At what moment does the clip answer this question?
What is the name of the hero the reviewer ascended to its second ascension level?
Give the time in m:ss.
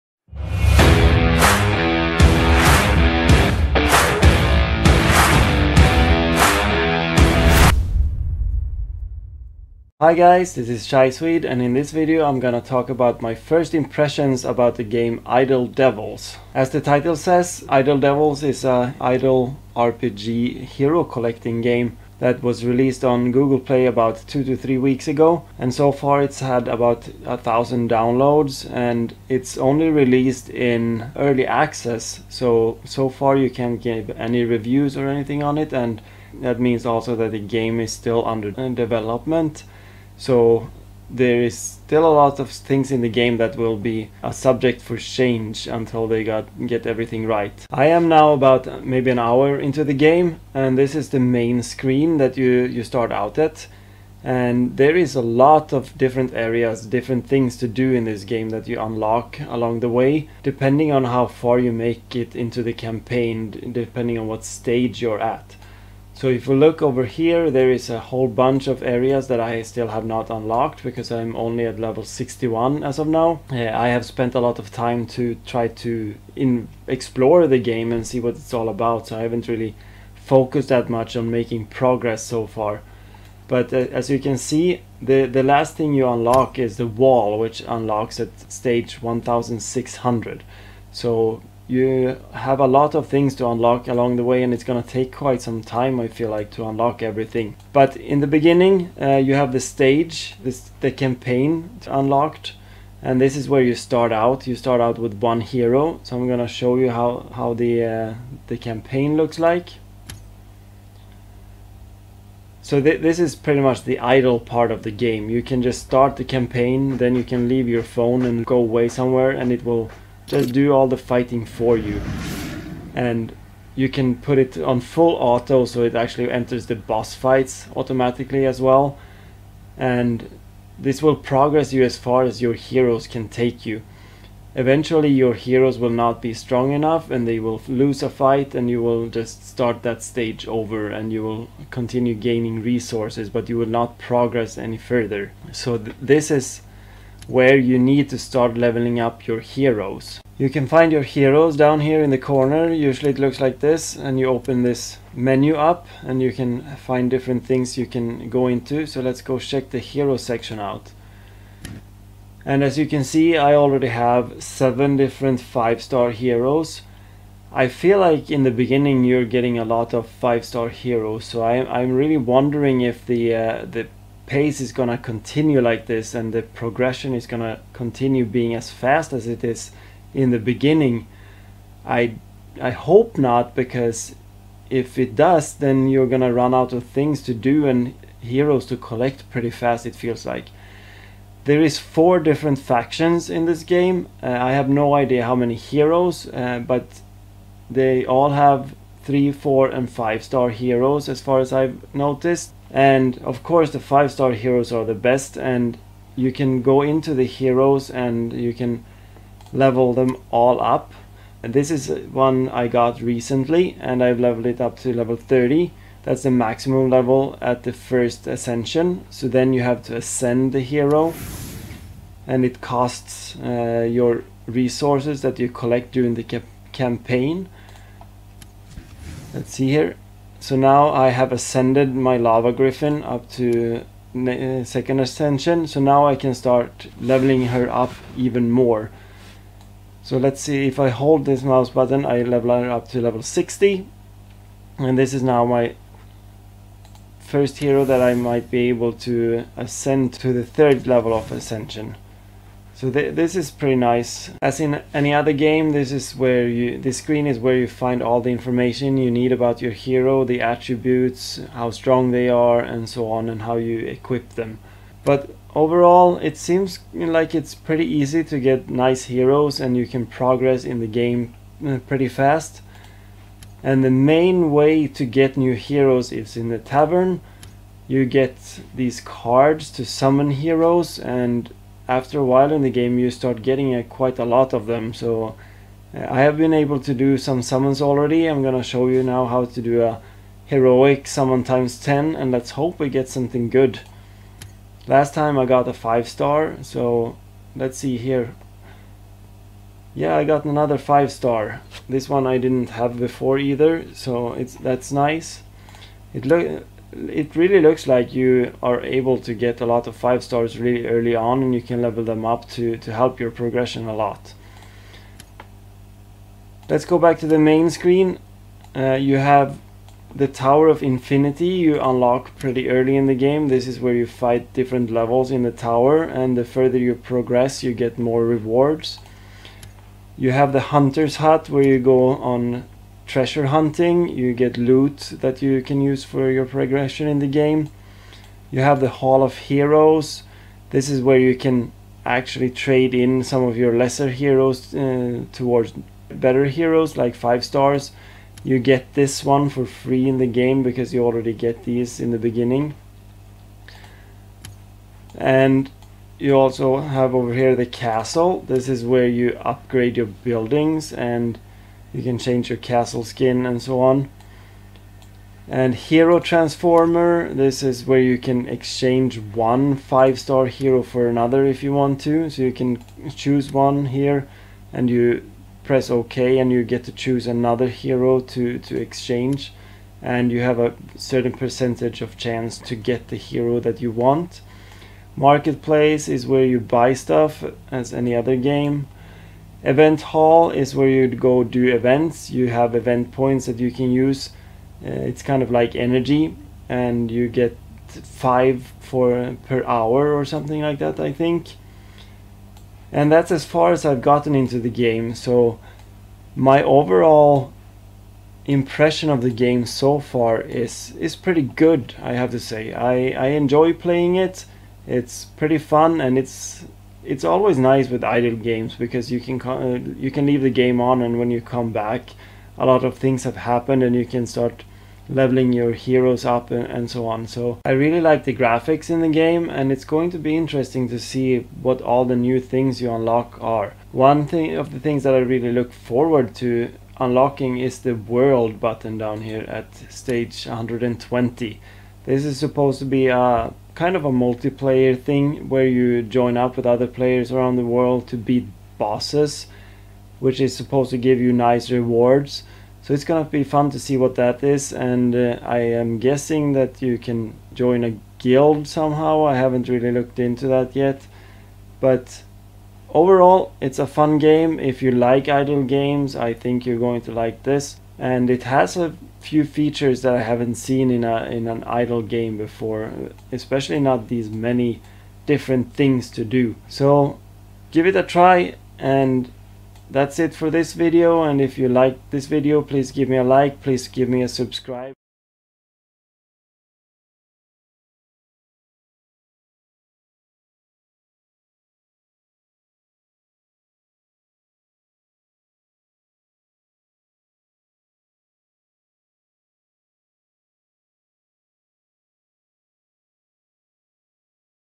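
3:52.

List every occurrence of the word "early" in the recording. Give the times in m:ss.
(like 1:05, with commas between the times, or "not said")
0:31, 5:10, 5:22.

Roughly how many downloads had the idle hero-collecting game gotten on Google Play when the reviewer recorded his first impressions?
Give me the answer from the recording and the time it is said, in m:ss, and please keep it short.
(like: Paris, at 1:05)
1000, at 0:26.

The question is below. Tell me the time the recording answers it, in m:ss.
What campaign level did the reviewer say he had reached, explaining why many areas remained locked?
1:11.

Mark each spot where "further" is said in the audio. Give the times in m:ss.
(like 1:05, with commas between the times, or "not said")
2:24, 5:26.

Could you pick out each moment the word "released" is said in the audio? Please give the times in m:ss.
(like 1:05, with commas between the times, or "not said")
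0:22, 0:29.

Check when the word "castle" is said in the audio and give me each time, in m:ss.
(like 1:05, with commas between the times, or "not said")
5:57, 6:02.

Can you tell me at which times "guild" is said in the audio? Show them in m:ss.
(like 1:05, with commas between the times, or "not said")
7:38.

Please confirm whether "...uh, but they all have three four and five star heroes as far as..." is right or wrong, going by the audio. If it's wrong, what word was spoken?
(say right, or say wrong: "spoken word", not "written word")
right.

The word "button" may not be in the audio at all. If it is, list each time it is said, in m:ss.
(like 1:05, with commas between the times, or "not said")
4:01, 7:18.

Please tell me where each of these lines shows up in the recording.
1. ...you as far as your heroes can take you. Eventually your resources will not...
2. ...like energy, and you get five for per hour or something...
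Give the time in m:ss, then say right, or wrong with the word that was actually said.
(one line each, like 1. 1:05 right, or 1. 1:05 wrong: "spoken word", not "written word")
1. 2:11 wrong: "heroes", not "resources"
2. 6:35 right.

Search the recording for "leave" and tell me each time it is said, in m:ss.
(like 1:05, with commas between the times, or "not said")
1:57, 7:00.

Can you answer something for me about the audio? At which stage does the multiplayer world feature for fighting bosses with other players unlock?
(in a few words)
120.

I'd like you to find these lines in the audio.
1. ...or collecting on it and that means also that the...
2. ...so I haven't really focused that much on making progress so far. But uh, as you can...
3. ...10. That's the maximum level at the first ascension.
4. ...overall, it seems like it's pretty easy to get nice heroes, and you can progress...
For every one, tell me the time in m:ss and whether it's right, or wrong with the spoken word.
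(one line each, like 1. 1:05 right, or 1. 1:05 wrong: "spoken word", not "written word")
1. 0:34 wrong: "anything", not "collecting"
2. 1:19 right
3. 3:35 wrong: "30", not "10"
4. 4:25 right.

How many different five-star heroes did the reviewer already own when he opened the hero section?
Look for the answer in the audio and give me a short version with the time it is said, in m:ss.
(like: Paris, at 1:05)
7, at 2:44.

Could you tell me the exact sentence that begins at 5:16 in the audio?
Let's go back to the main screen.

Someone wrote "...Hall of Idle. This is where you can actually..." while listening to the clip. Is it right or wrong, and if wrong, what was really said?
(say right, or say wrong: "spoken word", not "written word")
wrong: "Heroes", not "Idle".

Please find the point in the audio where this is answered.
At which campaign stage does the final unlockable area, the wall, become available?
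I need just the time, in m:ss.
1:28.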